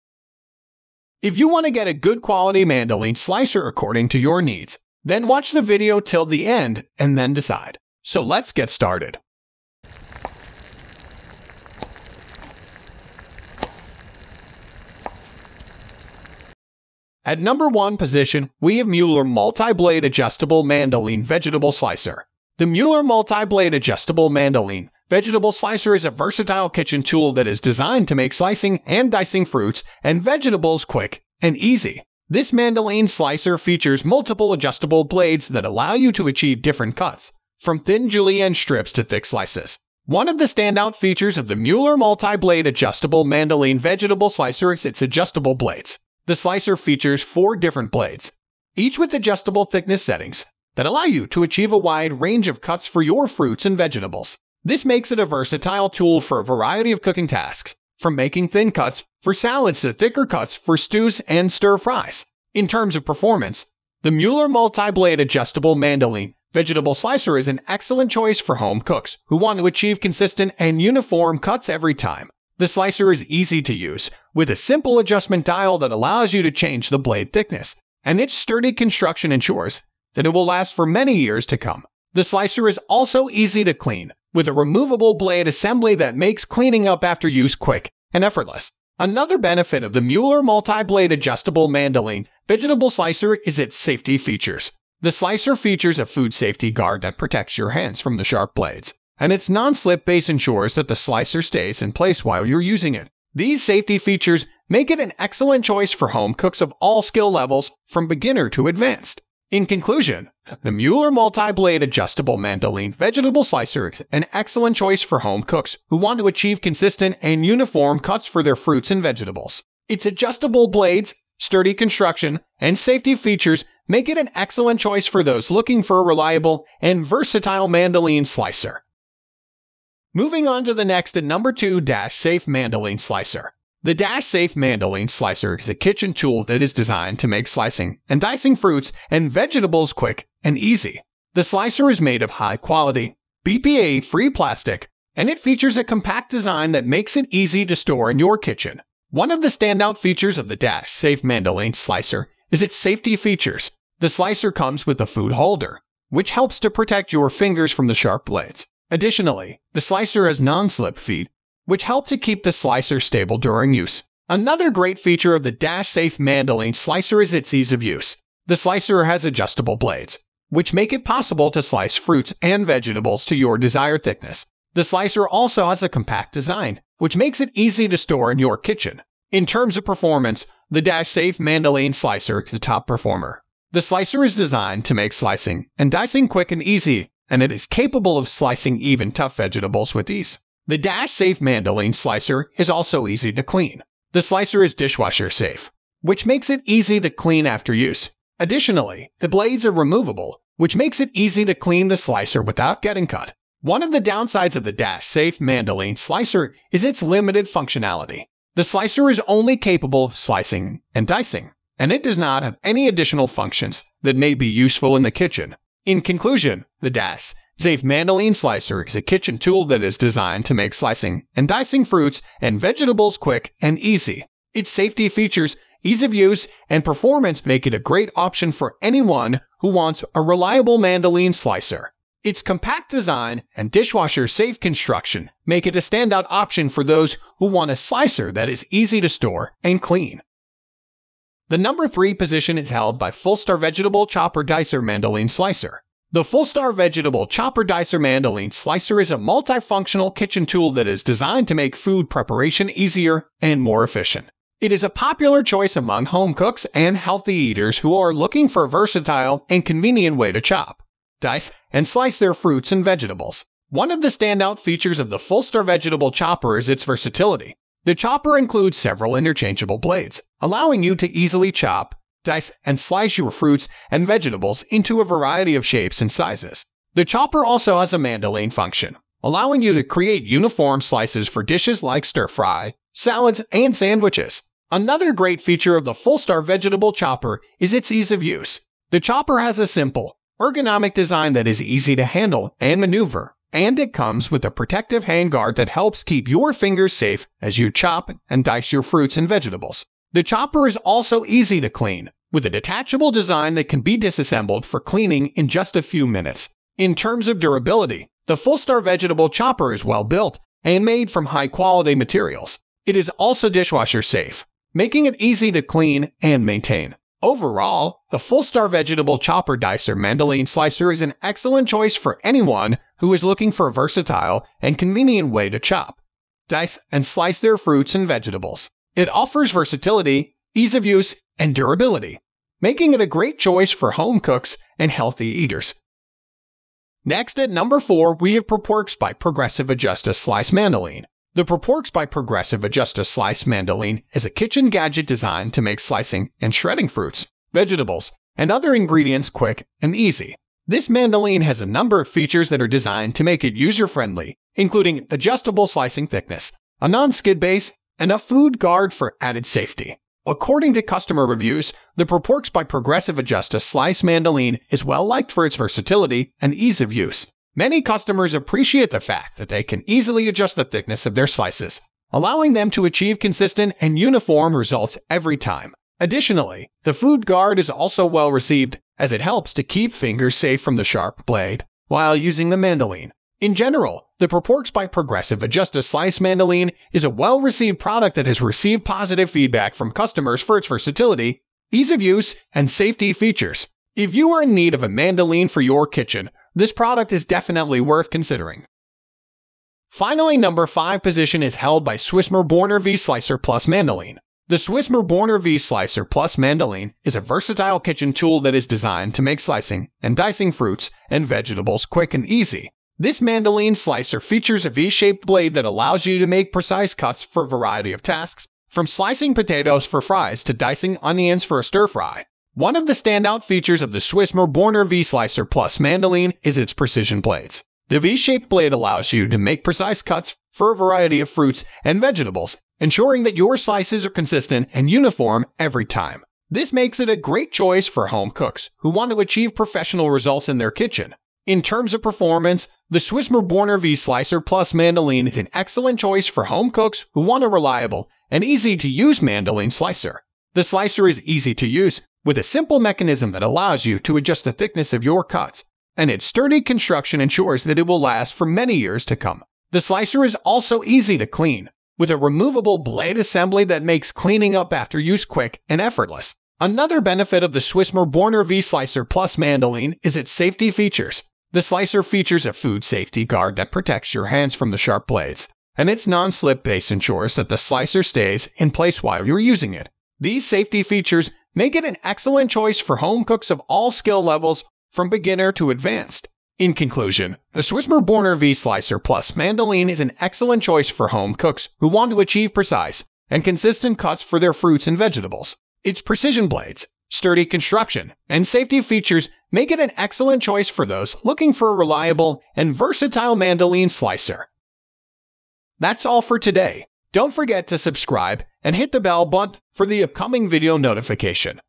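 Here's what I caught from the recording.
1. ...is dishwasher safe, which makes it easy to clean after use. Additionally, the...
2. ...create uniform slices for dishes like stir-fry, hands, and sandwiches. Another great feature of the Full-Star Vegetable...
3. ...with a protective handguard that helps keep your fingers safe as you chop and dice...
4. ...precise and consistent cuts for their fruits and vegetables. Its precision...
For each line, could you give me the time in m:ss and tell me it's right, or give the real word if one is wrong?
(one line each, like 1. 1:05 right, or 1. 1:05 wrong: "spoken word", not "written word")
1. 3:14 right
2. 4:39 wrong: "salads", not "hands"
3. 4:54 right
4. 8:12 right.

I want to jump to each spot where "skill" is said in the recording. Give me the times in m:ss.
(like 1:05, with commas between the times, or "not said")
1:47, 8:03.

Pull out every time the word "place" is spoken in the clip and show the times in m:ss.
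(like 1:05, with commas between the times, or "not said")
1:41, 7:58.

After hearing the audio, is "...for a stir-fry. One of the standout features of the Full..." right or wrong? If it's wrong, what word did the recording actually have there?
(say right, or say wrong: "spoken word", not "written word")
wrong: "Swiss", not "Full".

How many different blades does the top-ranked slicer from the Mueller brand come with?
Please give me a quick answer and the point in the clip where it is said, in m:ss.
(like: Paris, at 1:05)
4, at 0:47.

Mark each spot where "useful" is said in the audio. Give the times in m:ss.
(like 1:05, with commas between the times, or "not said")
3:34.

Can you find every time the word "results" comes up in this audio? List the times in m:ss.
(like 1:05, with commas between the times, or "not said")
6:14, 7:20.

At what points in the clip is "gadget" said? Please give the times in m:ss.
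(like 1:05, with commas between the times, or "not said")
5:44.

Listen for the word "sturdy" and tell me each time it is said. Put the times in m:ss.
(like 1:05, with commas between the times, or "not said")
1:18, 2:01, 7:36, 8:17.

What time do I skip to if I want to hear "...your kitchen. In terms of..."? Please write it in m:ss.
2:58.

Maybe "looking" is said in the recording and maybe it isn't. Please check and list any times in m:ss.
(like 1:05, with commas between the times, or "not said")
2:05, 4:18, 5:23, 8:21.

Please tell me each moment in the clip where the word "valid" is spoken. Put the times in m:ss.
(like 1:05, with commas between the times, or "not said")
not said.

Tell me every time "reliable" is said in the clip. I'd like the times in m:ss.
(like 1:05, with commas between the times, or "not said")
2:06, 3:50, 7:27, 8:21.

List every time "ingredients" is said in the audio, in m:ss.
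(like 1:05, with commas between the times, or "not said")
5:48.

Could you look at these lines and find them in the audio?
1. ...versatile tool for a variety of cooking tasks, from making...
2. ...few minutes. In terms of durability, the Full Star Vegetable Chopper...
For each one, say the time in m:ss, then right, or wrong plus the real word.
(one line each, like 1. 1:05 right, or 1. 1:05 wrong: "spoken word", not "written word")
1. 0:55 right
2. 5:05 right.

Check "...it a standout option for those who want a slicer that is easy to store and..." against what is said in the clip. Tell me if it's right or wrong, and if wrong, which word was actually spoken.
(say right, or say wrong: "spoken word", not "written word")
right.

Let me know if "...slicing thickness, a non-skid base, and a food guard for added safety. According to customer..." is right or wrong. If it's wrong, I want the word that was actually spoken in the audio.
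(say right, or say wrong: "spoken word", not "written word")
right.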